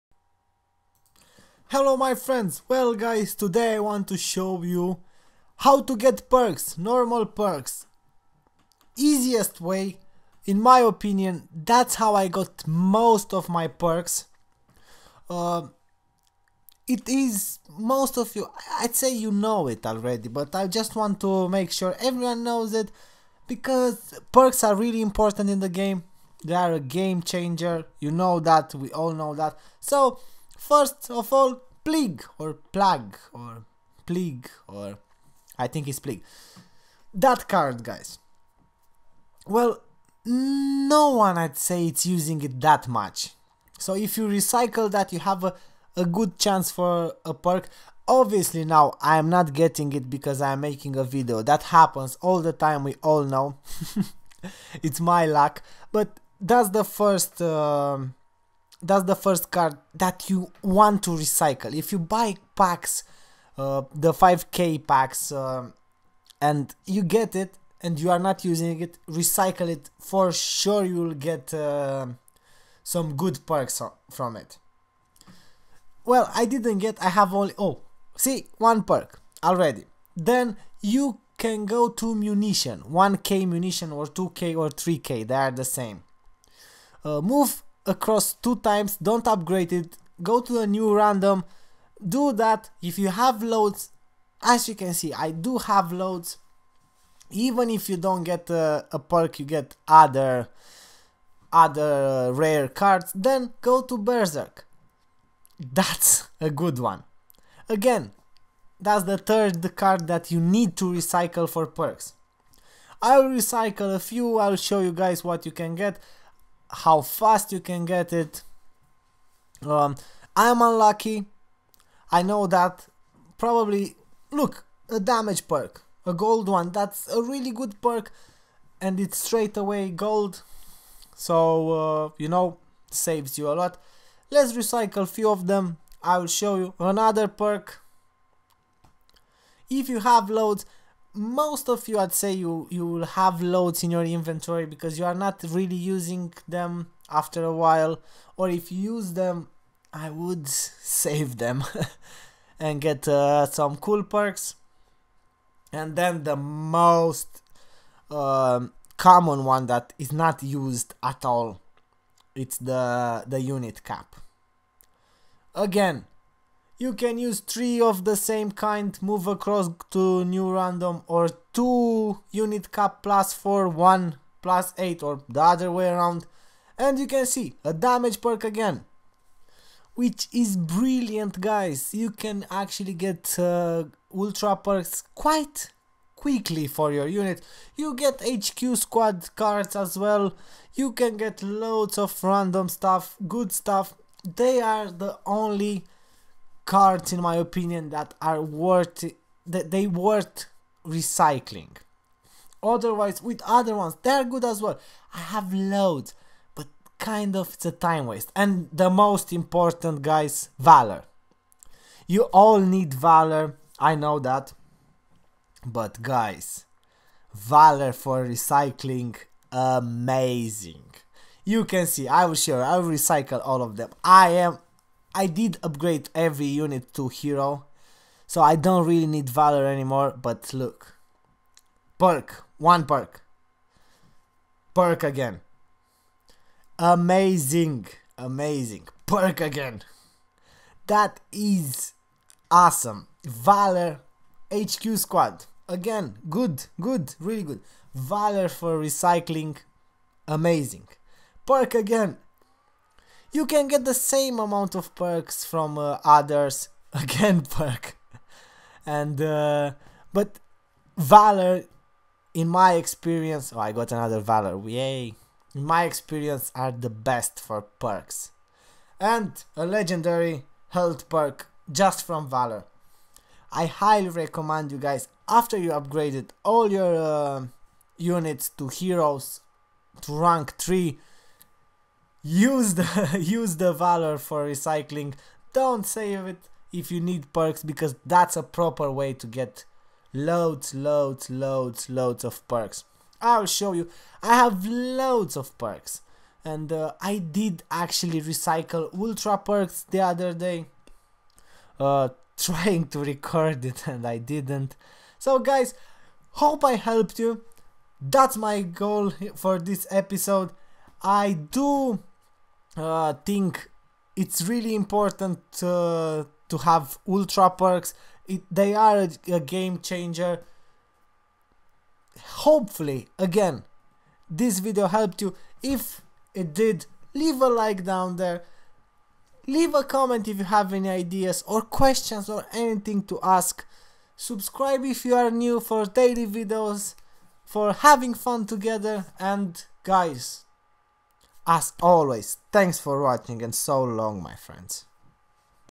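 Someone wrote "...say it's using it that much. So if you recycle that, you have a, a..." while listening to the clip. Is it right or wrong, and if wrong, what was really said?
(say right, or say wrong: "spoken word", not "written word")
right.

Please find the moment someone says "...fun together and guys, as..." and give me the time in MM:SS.
05:38.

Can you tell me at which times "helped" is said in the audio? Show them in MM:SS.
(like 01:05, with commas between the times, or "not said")
05:06, 05:24.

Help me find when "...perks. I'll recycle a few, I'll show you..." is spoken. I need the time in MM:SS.
01:51.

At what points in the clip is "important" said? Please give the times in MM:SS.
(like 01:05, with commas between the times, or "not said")
00:24, 03:29, 05:14.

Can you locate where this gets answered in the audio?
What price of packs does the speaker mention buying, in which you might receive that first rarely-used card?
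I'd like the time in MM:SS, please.
01:03.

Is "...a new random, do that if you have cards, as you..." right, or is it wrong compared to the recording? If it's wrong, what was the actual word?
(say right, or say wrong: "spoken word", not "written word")
wrong: "loads", not "cards".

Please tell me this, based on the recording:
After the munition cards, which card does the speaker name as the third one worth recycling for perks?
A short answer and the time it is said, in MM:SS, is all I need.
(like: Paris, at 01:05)
Berserk, at 01:43.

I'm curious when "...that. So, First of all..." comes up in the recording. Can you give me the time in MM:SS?
00:29.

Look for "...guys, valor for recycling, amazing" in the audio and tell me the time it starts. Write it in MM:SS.
03:36.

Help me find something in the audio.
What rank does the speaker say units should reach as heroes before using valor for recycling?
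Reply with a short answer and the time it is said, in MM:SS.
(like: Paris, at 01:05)
rank 3, at 04:40.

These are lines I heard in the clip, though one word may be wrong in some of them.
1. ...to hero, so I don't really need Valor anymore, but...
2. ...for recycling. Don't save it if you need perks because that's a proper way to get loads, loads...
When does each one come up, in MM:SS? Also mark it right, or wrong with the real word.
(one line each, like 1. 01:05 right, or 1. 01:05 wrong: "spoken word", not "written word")
1. 03:46 right
2. 04:44 right.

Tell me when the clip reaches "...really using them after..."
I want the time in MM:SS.
02:25.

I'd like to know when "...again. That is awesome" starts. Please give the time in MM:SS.
03:59.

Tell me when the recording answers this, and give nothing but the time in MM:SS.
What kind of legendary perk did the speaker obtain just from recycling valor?
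04:29.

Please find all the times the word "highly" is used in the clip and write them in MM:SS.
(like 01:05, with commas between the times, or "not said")
04:33.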